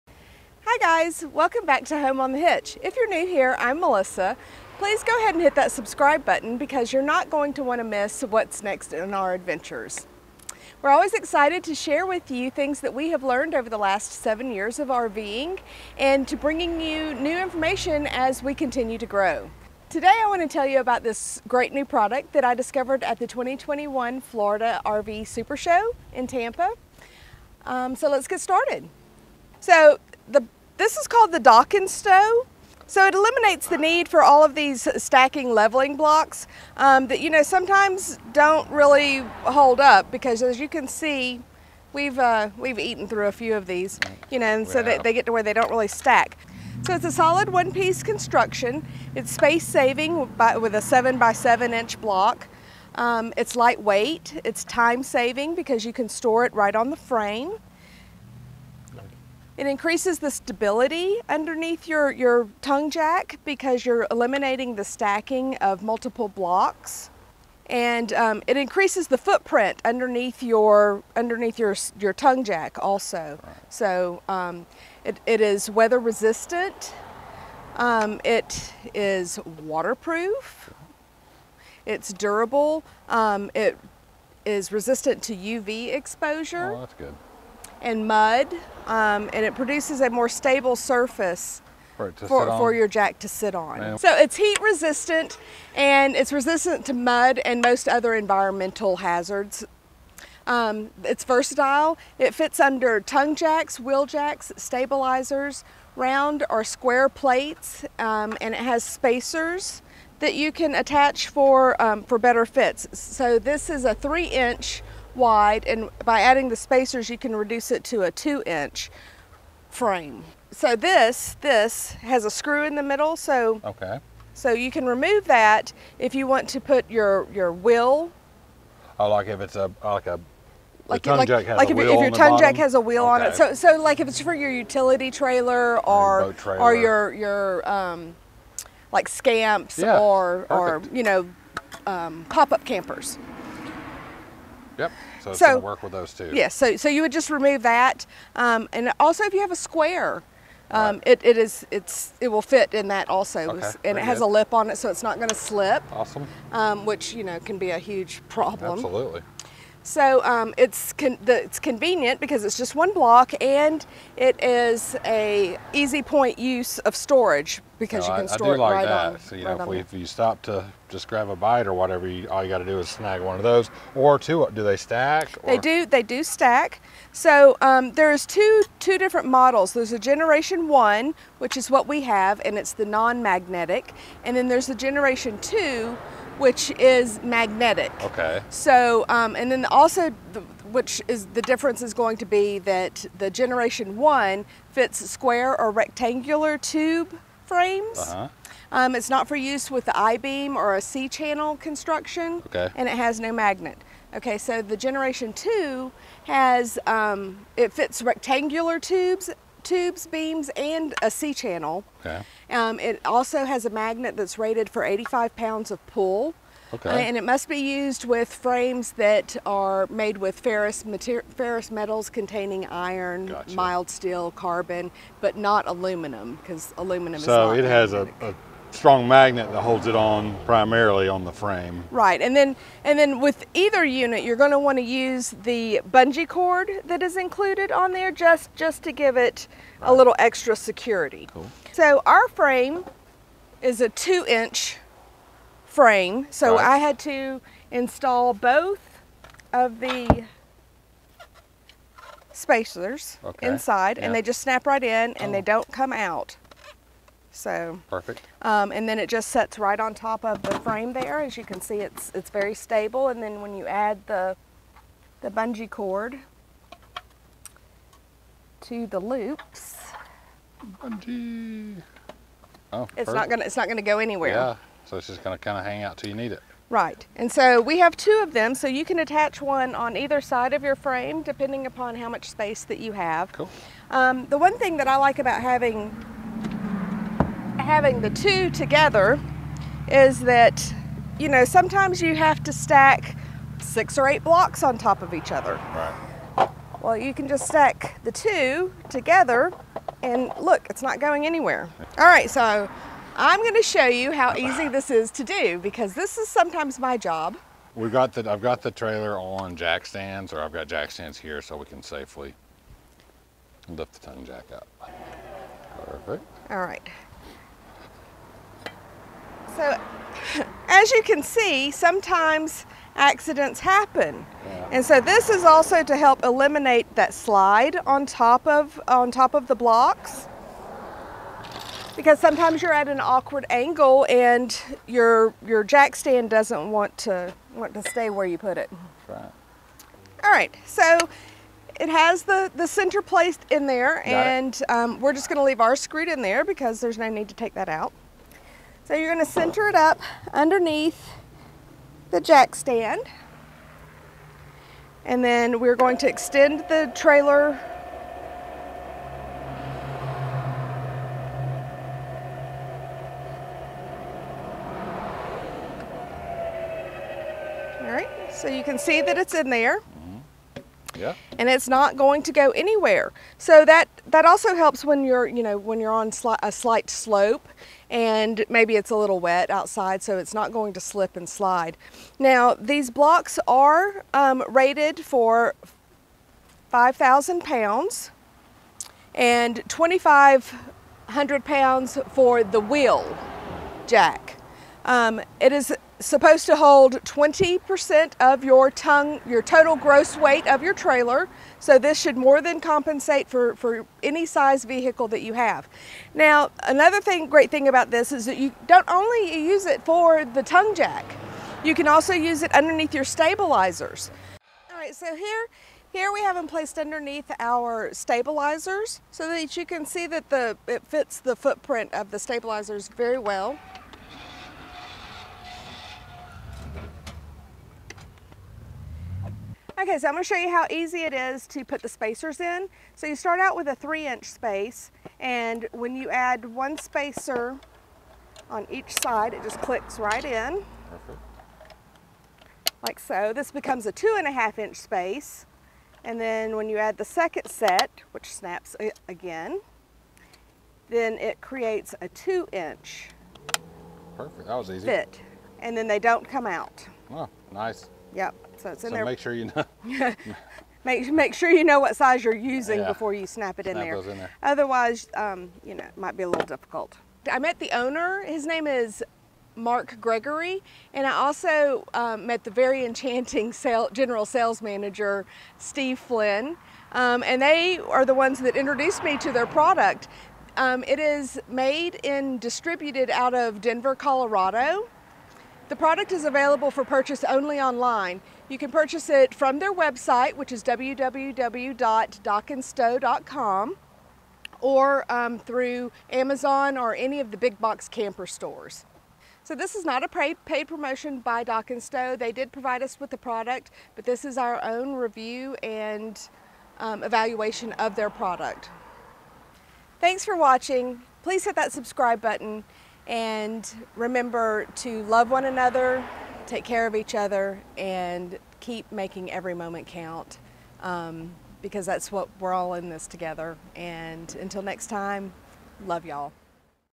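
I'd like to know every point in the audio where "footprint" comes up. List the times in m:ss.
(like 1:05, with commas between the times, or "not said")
1:09, 7:01.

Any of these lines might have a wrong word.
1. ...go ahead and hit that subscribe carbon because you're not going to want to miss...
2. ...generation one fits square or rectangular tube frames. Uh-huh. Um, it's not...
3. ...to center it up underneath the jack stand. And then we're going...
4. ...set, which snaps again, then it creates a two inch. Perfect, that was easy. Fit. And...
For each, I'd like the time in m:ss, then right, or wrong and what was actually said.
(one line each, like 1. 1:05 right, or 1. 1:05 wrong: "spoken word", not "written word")
1. 0:05 wrong: "button", not "carbon"
2. 3:13 right
3. 5:49 right
4. 7:27 right.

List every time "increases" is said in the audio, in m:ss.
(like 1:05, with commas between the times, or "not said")
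0:59, 1:08.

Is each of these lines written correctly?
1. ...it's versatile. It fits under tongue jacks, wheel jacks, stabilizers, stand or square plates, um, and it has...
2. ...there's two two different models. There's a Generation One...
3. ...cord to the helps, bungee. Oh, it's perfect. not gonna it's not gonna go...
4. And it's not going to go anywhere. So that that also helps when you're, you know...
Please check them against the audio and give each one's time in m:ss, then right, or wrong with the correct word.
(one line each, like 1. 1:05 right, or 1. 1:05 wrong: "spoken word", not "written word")
1. 1:41 wrong: "round", not "stand"
2. 2:57 right
3. 4:25 wrong: "loops", not "helps"
4. 6:11 right.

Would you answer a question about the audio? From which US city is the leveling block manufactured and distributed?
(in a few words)
Denver, Colorado.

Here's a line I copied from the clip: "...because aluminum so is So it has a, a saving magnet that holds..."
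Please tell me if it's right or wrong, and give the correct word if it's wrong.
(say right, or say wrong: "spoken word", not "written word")
wrong: "strong", not "saving".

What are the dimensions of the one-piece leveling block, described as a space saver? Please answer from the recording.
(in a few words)
7 by 7 inch.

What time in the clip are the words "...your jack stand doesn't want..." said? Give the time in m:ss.
5:35.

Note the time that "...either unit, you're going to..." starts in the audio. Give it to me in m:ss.
3:53.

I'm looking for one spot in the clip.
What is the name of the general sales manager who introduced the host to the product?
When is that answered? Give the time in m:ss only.
7:55.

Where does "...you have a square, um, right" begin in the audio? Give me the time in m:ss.
2:29.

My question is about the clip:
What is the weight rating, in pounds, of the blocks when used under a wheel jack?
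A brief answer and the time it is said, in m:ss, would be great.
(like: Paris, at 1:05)
2,500, at 6:29.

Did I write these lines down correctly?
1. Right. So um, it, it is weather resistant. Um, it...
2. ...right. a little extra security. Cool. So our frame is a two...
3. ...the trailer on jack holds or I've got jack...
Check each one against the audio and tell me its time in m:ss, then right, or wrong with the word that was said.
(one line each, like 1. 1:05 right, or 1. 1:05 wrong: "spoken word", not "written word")
1. 1:13 right
2. 3:59 right
3. 5:08 wrong: "stands", not "holds".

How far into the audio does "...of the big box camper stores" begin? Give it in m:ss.
8:17.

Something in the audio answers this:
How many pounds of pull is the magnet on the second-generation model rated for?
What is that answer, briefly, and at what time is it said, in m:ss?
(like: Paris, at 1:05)
85, at 3:34.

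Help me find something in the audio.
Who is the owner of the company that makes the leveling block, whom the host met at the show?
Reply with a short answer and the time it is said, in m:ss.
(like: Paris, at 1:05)
Mark Gregory, at 7:49.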